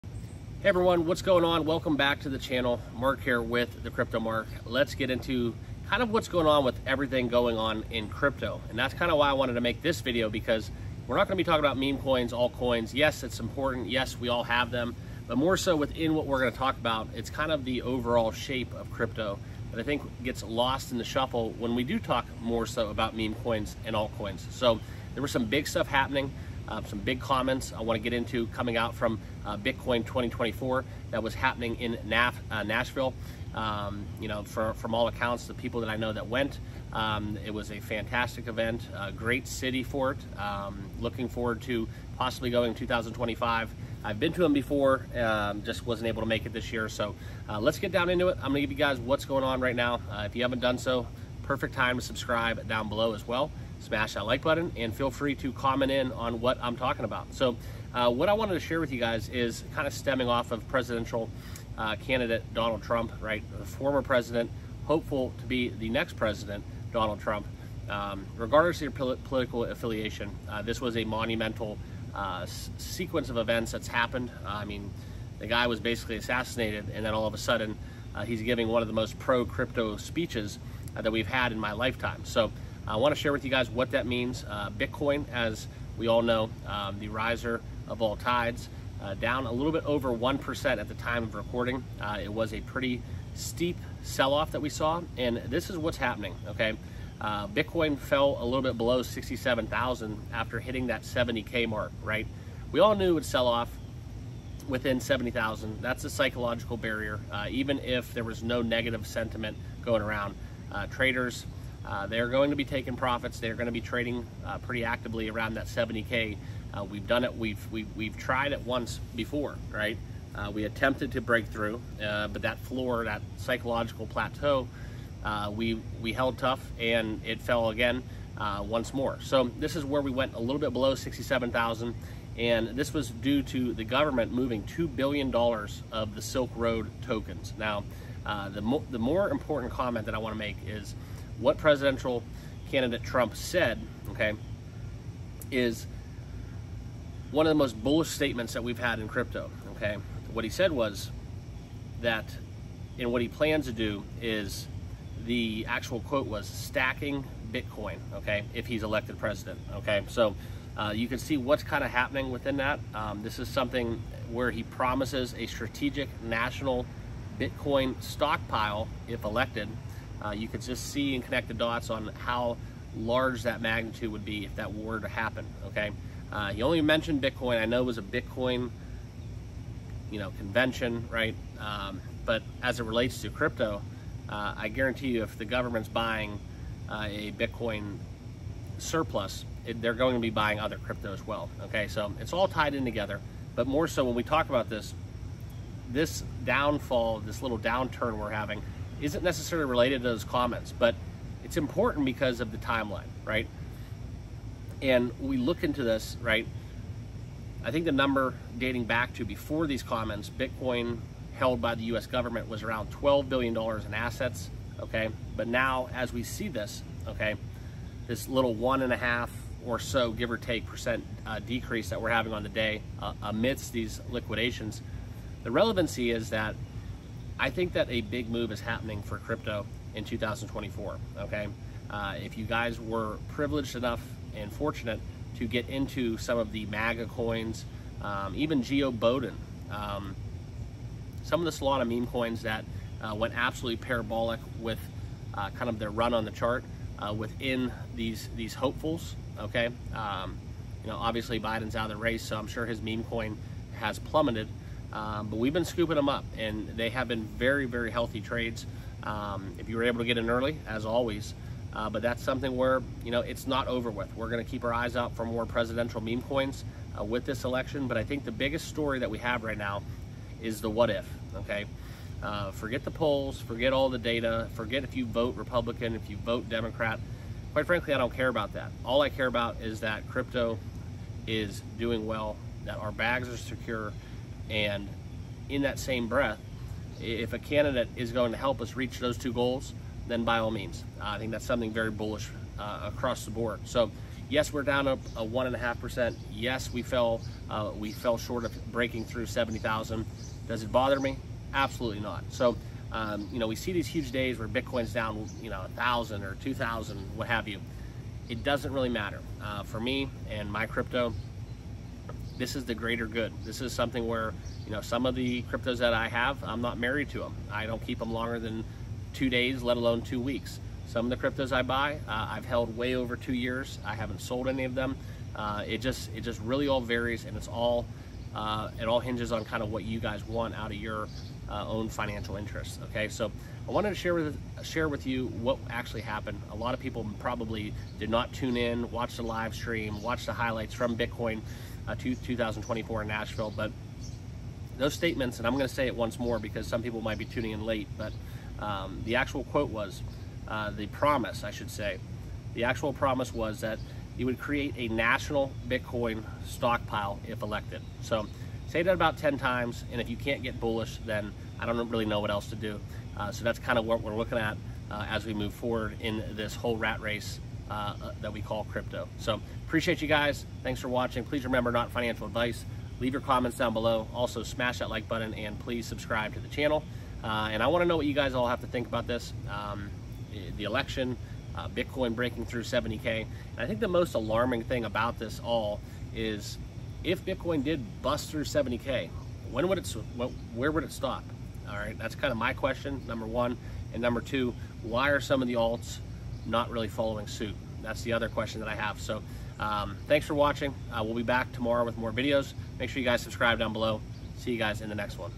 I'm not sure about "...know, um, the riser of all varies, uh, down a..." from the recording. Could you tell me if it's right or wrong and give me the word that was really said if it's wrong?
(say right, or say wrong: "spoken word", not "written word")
wrong: "tides", not "varies".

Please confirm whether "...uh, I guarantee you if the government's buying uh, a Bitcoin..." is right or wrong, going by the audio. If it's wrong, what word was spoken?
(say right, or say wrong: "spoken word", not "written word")
right.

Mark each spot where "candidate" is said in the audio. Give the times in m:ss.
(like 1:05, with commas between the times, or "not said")
1:01, 2:22, 4:47.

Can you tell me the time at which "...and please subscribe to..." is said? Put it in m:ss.
6:15.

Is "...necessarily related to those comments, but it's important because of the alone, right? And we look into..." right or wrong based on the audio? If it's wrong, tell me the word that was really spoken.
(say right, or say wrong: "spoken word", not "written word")
wrong: "timeline", not "alone".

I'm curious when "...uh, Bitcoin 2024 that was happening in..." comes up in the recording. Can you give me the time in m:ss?
0:29.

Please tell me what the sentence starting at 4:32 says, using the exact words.
Uh, forget the polls, forget all the data, forget if you vote Republican, if you vote Democrat.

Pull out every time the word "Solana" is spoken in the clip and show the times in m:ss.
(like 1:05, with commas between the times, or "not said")
4:01.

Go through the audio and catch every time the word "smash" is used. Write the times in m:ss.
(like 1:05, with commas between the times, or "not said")
0:53, 6:14.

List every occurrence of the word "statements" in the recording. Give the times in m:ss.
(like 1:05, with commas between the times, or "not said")
2:28, 5:44.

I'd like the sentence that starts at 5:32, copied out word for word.
Okay, so I wanted to share with share with you what actually happened.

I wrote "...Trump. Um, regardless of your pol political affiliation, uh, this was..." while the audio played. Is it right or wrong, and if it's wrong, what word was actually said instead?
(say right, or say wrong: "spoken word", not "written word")
right.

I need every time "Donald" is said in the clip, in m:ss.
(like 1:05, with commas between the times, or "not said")
1:02, 1:06.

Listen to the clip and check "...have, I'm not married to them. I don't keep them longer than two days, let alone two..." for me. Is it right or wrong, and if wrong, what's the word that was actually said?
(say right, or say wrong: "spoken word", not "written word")
right.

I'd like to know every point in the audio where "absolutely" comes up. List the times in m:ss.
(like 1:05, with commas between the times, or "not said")
4:03, 5:01.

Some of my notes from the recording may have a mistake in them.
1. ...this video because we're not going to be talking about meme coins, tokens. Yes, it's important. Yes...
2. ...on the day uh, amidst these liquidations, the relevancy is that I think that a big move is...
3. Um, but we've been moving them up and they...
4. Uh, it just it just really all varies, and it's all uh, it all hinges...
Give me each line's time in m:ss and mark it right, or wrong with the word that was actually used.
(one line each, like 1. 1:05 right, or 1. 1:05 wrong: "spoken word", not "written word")
1. 0:09 wrong: "altcoins", not "tokens"
2. 3:42 right
3. 4:14 wrong: "scooping", not "moving"
4. 5:25 right.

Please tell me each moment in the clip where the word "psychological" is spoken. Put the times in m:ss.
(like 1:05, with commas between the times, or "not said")
1:46, 2:03.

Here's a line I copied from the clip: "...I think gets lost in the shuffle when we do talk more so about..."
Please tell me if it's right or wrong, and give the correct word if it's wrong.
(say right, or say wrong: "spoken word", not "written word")
right.